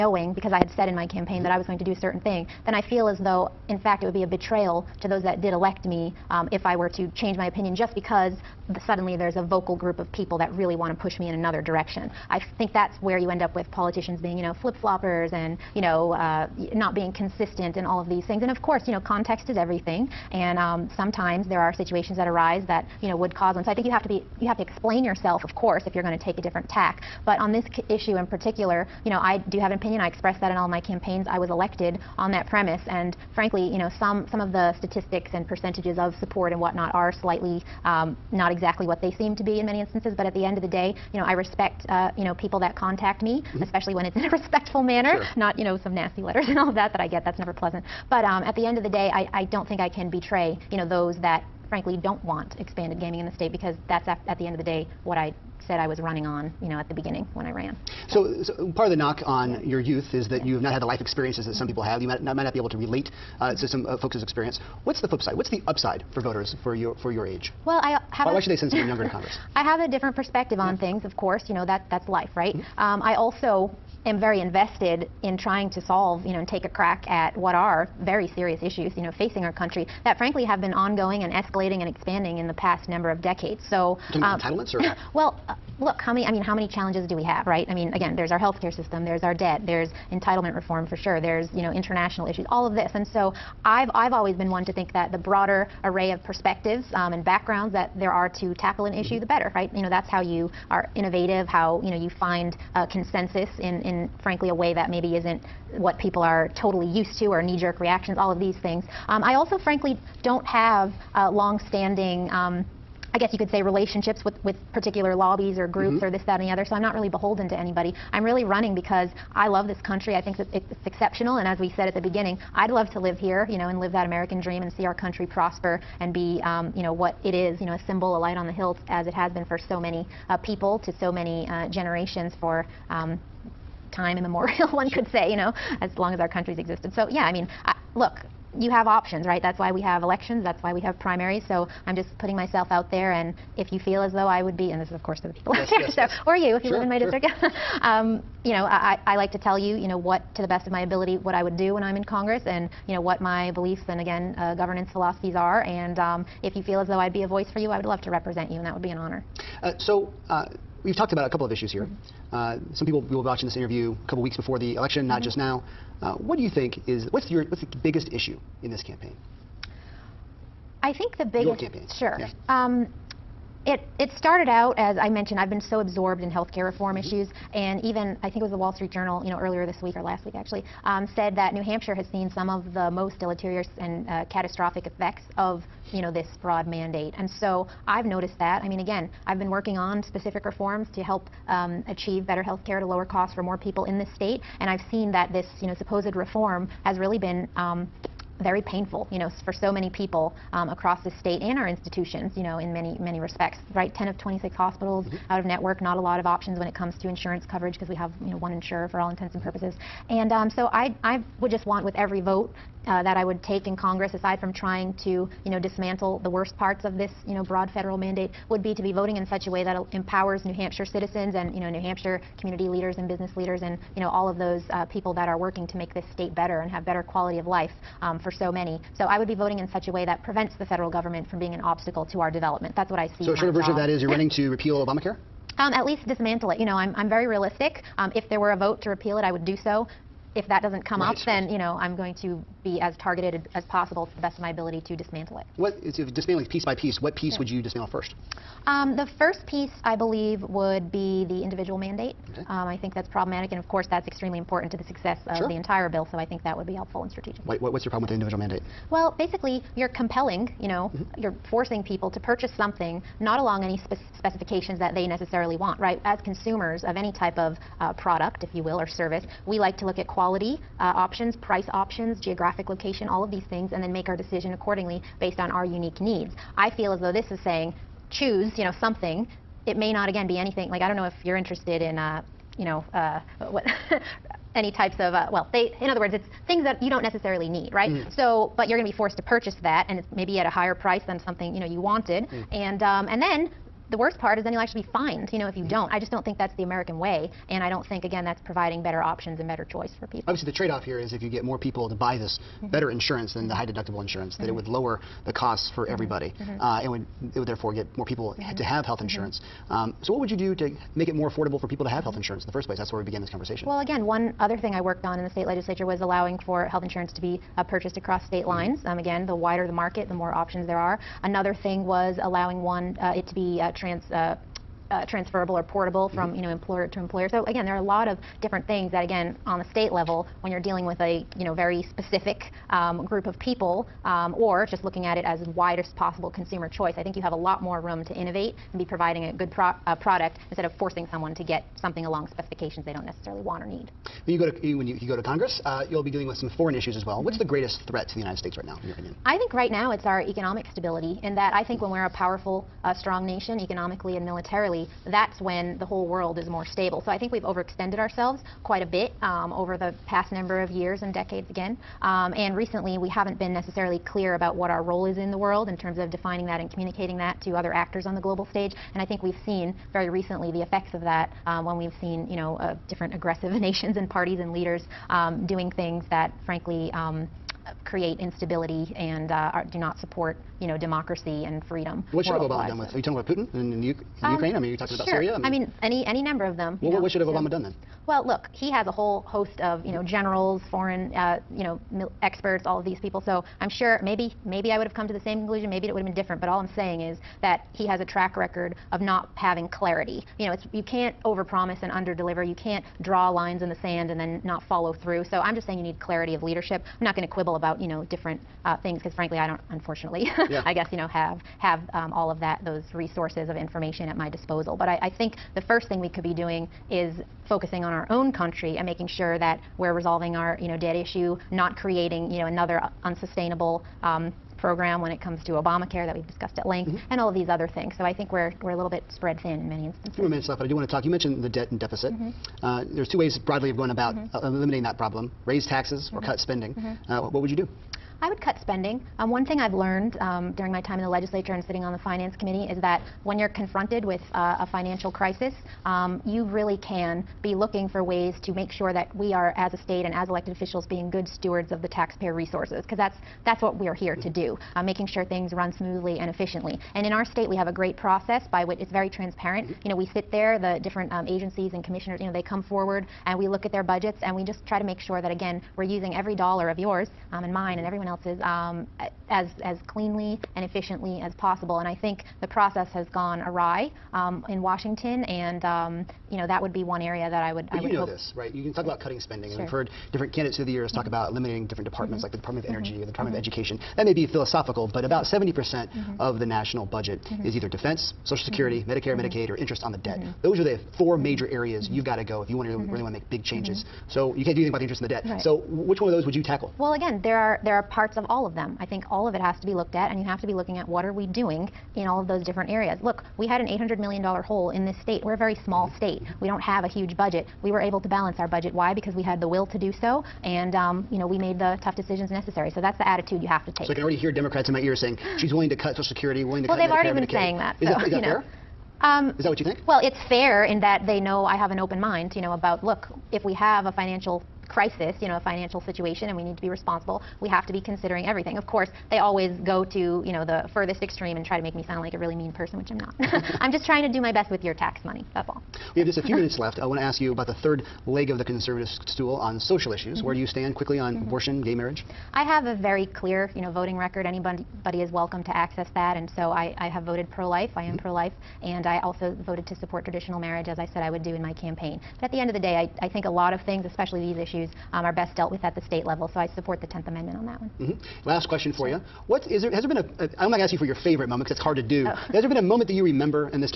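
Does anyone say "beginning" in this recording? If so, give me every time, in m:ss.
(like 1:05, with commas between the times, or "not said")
0:56, 2:02.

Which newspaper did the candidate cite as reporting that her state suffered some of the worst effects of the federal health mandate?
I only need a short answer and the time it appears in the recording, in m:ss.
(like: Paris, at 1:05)
Wall Street Journal, at 2:58.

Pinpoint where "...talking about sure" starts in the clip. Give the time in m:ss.
6:24.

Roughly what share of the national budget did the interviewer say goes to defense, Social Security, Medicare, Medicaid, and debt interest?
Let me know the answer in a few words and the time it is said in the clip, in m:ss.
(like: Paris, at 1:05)
70%, at 8:05.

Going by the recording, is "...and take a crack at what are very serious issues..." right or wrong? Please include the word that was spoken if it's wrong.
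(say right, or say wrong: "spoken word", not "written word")
right.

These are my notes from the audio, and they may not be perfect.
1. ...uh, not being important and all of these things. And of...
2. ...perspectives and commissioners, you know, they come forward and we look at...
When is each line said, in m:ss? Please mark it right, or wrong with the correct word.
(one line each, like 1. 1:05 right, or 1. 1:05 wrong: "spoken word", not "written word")
1. 0:16 wrong: "consistent", not "important"
2. 7:41 wrong: "agencies", not "perspectives".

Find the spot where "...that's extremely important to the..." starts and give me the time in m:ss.
4:13.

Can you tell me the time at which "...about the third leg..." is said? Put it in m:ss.
8:57.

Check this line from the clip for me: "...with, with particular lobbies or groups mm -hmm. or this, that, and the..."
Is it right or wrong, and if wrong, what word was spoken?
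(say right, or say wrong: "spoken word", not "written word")
right.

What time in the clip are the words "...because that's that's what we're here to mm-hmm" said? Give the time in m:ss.
7:32.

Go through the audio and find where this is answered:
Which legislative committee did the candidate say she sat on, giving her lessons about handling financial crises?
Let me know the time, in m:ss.
7:22.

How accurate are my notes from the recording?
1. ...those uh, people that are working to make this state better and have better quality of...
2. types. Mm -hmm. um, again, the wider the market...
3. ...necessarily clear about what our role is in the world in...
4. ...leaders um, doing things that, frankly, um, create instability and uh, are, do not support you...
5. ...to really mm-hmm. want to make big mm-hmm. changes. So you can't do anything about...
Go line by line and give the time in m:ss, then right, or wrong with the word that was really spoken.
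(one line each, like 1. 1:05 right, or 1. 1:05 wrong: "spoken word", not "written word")
1. 3:44 right
2. 5:18 wrong: "lines", not "types"
3. 6:03 right
4. 6:14 right
5. 8:12 right.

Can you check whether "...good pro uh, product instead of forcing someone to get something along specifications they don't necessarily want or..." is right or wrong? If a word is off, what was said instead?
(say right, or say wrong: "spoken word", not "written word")
right.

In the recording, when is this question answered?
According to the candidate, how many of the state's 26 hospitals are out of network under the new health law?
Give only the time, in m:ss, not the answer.
3:23.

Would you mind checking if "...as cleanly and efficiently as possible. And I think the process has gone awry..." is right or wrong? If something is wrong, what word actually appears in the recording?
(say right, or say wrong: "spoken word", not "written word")
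right.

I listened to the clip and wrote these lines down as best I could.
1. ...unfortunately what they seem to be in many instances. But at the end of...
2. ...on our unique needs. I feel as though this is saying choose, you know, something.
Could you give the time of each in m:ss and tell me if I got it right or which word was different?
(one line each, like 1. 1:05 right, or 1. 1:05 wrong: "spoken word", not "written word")
1. 0:38 wrong: "exactly", not "unfortunately"
2. 4:35 right.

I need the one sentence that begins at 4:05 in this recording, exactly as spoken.
What, if dismantling piece by piece, what piece yeah.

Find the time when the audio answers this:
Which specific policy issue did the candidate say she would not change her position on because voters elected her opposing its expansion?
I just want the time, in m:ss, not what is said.
0:52.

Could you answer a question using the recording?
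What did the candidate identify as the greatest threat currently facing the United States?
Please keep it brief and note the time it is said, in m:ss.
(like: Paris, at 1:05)
Economic stability, at 5:50.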